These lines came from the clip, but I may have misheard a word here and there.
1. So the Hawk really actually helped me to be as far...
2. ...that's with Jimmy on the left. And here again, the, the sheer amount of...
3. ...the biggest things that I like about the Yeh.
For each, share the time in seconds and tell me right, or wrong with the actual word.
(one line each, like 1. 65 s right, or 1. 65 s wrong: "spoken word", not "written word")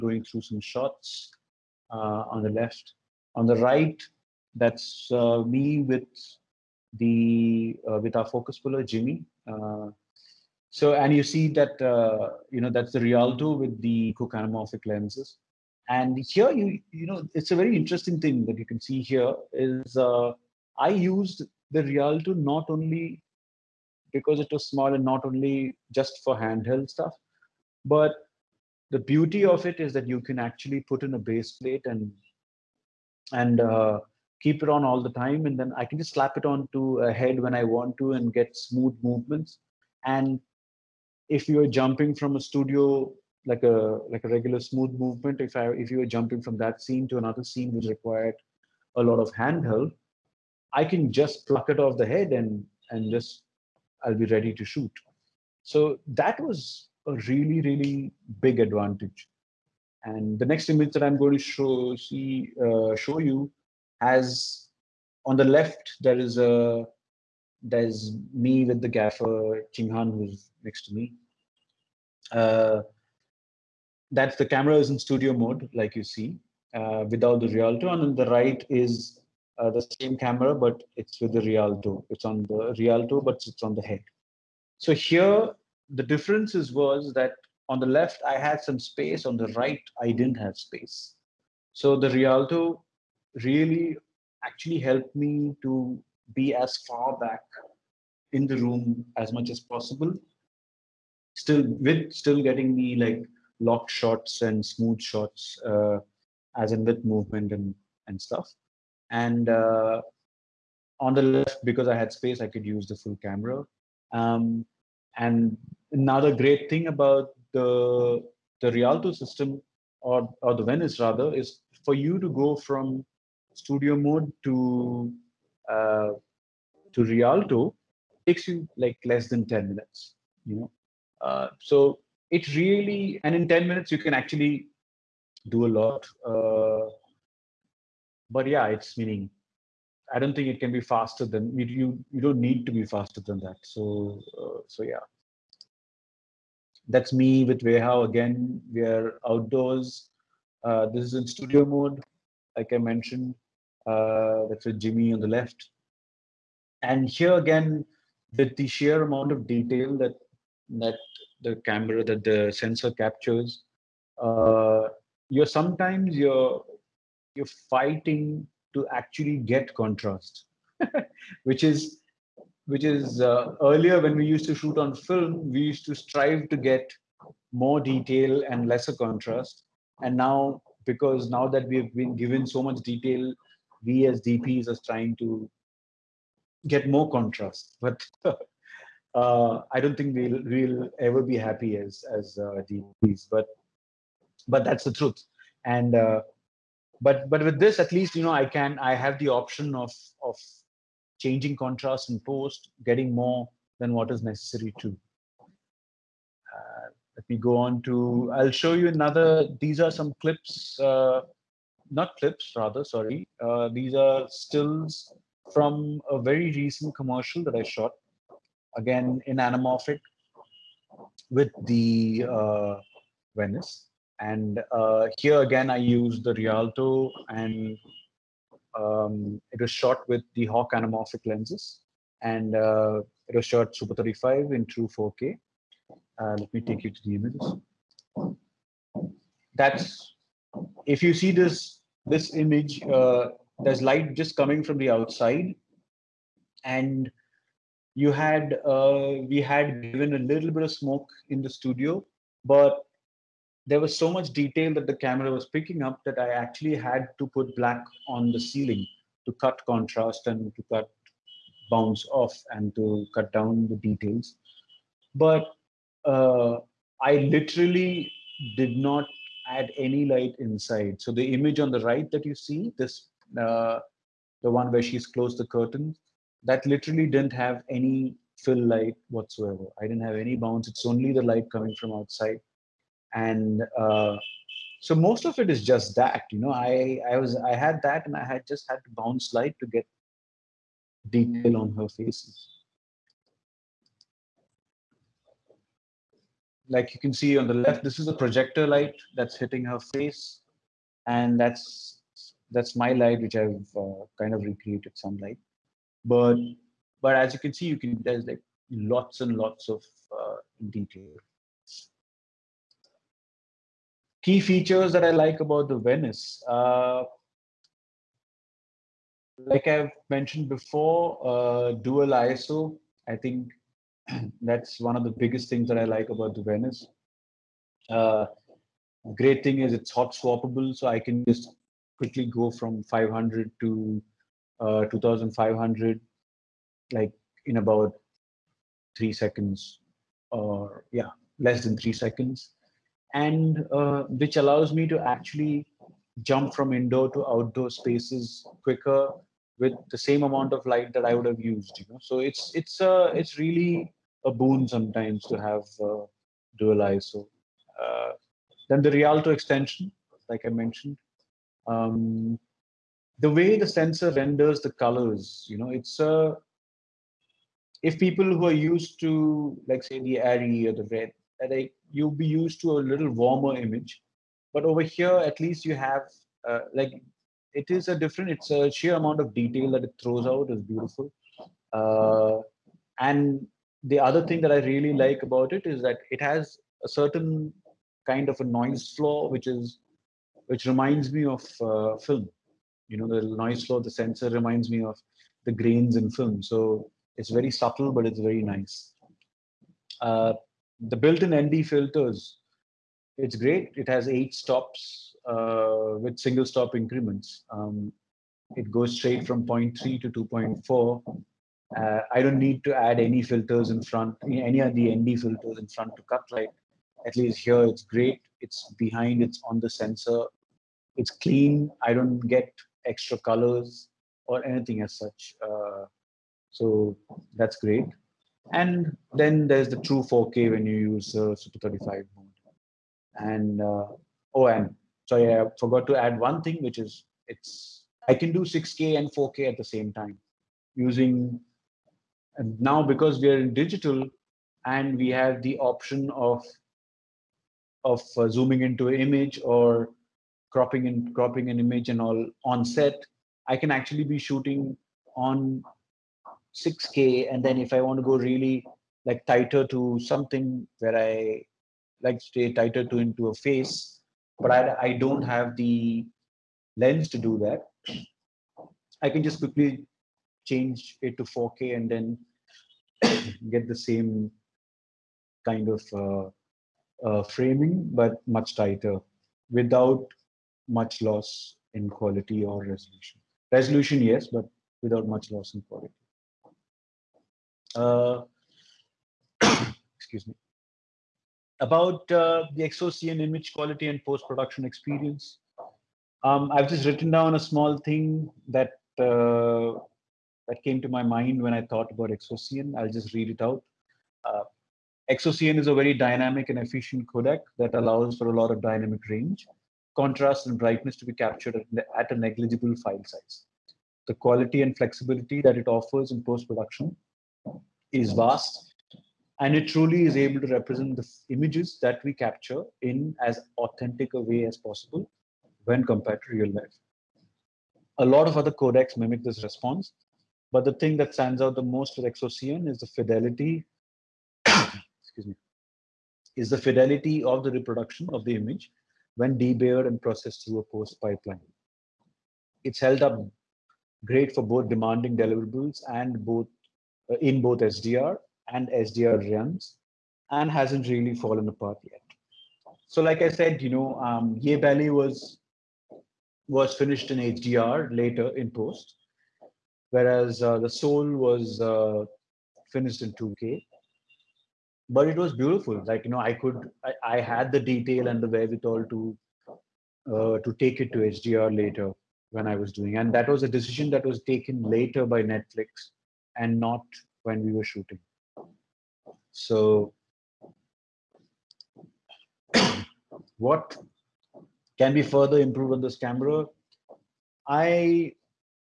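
1. 91 s wrong: "Rialto", not "Hawk"
2. 154 s right
3. 325 s wrong: "Venice", not "Yeh".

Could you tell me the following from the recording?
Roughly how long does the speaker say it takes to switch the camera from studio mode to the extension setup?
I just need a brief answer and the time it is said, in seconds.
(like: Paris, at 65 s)
less than 10 minutes, at 129 s.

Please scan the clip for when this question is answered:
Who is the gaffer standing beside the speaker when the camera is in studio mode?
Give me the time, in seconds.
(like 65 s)
69 s.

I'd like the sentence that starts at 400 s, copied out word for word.
Uh, the built-in ND filters, it's great.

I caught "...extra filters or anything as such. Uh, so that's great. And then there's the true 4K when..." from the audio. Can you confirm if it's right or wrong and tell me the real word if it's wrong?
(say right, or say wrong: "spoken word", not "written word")
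wrong: "colors", not "filters".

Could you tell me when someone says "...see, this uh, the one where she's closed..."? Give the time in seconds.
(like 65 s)
272 s.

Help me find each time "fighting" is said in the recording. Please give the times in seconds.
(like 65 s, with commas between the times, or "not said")
167 s.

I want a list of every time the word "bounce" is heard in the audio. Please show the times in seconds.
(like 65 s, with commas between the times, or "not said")
261 s, 280 s, 288 s.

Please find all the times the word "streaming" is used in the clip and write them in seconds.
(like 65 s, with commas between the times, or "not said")
not said.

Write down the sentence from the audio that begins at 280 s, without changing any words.
It's only the light coming from outside, and uh, so most of it is just that.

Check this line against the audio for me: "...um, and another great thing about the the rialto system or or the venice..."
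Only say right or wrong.
right.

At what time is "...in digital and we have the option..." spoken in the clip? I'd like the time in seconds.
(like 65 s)
443 s.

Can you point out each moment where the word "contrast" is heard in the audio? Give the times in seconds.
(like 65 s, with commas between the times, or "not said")
169 s, 178 s, 187 s, 201 s, 259 s, 509 s.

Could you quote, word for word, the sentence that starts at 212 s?
Sorry, uh, these are stills from a very recent commercial that I shot.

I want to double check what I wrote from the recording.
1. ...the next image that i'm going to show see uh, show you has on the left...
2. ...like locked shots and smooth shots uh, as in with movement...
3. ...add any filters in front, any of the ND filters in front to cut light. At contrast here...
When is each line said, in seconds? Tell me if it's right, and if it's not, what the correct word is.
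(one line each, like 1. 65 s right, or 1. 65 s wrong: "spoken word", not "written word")
1. 60 s right
2. 102 s right
3. 412 s wrong: "least", not "contrast".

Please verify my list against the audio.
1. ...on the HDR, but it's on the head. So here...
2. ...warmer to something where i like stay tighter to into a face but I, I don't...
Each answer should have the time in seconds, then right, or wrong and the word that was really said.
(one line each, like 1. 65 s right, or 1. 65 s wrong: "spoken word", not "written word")
1. 82 s wrong: "Rialto", not "HDR"
2. 459 s wrong: "tighter", not "warmer".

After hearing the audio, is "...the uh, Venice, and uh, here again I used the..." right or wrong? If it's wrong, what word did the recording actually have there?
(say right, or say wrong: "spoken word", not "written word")
right.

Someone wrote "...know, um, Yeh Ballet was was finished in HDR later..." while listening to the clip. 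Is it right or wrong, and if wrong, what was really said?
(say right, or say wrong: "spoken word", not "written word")
right.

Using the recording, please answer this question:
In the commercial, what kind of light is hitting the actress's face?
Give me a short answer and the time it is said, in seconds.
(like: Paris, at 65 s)
projector light, at 298 s.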